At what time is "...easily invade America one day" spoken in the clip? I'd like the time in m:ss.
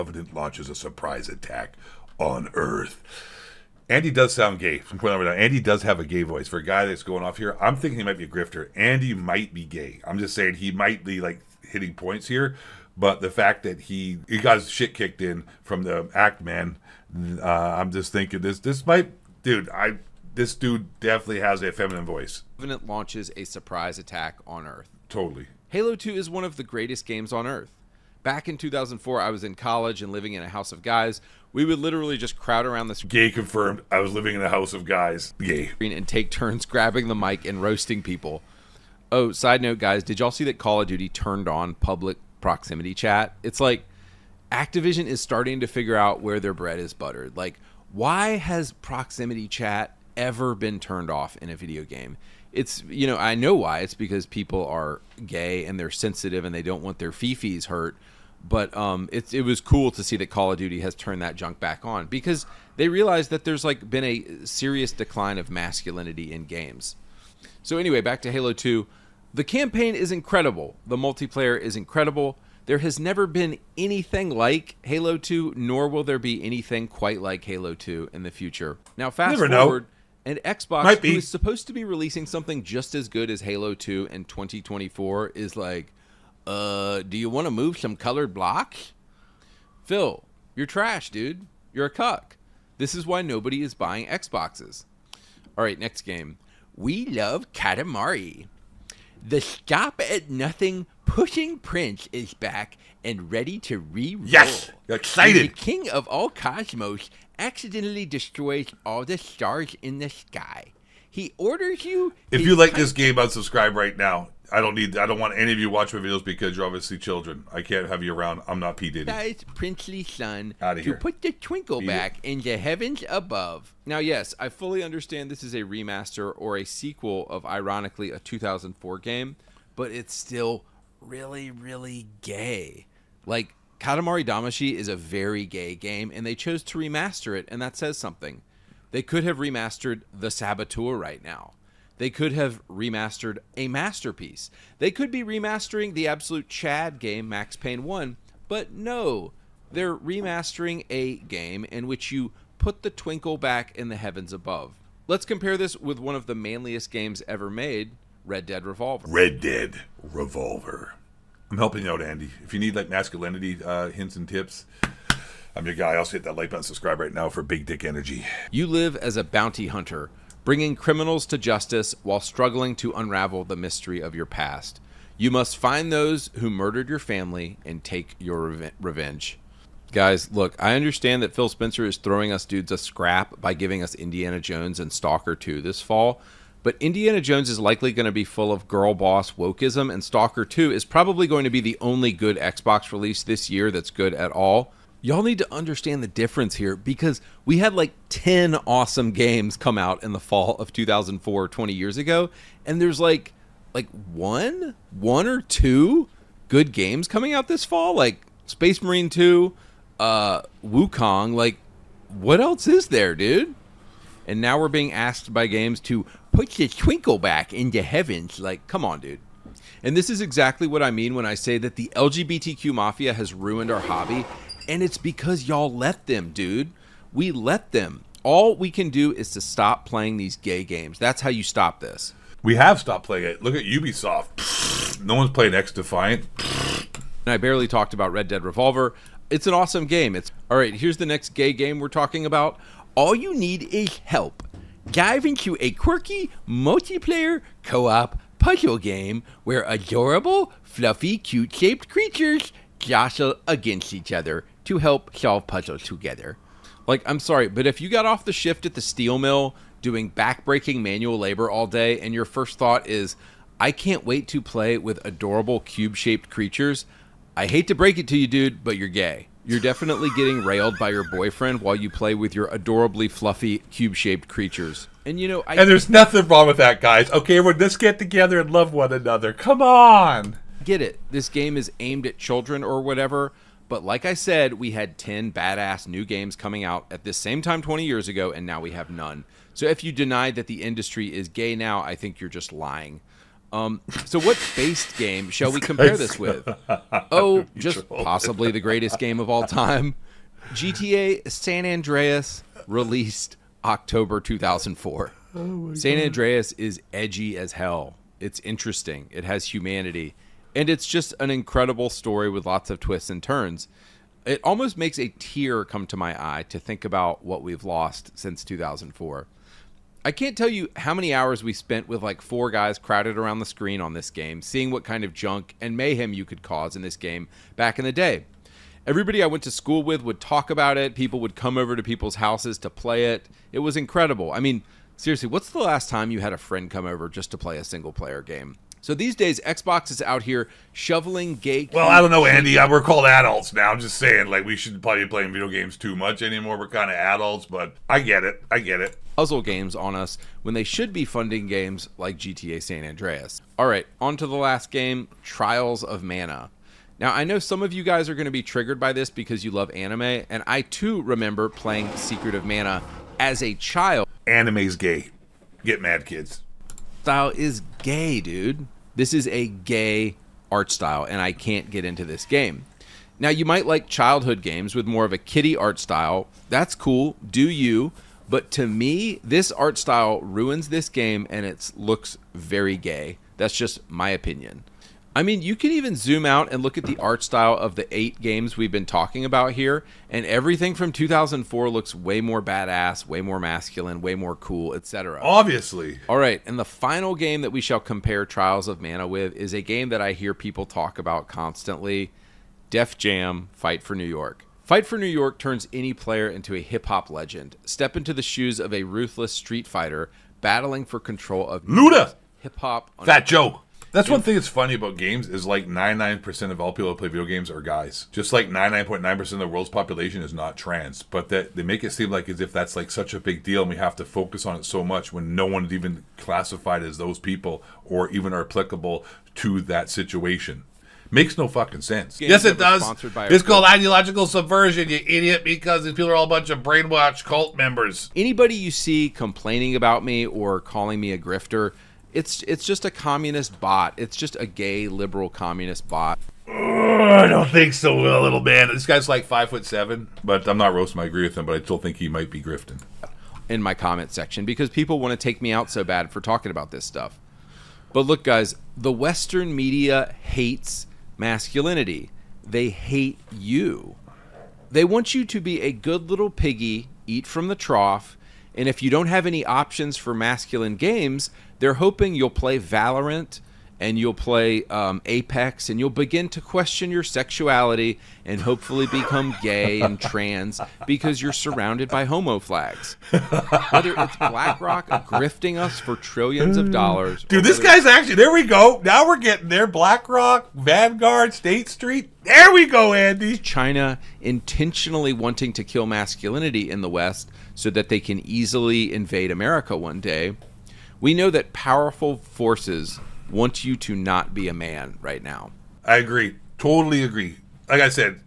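8:18.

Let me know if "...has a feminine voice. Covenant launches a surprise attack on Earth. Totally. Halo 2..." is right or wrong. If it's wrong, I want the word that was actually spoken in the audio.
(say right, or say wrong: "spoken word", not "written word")
right.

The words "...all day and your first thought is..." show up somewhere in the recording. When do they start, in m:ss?
4:21.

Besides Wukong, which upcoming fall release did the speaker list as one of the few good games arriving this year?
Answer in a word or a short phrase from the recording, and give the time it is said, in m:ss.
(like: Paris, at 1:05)
Space Marine 2, at 3:28.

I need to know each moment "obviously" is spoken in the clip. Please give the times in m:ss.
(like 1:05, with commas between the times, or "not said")
1:56, 6:35.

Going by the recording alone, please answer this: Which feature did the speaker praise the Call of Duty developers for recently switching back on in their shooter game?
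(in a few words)
Public proximity chat.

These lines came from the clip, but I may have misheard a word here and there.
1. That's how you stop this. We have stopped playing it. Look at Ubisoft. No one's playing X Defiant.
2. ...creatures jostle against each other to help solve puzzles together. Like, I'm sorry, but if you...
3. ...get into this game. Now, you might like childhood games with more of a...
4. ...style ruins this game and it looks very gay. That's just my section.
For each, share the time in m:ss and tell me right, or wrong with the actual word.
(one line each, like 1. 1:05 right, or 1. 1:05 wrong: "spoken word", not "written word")
1. 3:50 right
2. 4:11 right
3. 6:11 right
4. 6:19 wrong: "opinion", not "section".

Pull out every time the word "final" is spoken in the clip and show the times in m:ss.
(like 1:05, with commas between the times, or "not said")
6:36.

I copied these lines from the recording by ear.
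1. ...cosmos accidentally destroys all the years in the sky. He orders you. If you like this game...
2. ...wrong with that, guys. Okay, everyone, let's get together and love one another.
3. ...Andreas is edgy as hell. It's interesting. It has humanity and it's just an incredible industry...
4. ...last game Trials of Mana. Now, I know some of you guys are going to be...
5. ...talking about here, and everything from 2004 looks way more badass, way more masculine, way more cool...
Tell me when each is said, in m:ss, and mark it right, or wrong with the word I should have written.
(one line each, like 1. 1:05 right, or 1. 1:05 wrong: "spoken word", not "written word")
1. 1:46 wrong: "stars", not "years"
2. 4:36 right
3. 5:05 wrong: "story", not "industry"
4. 5:54 right
5. 6:28 right.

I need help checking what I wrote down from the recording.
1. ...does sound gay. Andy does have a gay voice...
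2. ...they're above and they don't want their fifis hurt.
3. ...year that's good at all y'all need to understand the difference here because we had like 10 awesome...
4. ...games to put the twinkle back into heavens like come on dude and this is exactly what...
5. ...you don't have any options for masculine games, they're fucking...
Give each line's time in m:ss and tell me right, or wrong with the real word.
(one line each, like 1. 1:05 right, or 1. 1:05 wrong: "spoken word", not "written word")
1. 0:04 right
2. 0:55 wrong: "sensitive", not "above"
3. 3:13 right
4. 3:35 right
5. 7:48 wrong: "hoping", not "fucking".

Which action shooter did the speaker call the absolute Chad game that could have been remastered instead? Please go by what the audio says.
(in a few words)
Max Payne 1.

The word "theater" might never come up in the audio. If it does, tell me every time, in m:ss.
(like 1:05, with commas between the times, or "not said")
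not said.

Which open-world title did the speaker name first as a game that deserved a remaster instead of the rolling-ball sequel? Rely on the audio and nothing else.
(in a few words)
The Saboteur.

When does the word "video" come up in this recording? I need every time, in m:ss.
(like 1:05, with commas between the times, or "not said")
0:51, 1:55, 5:45, 6:57.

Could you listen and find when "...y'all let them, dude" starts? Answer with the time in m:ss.
3:45.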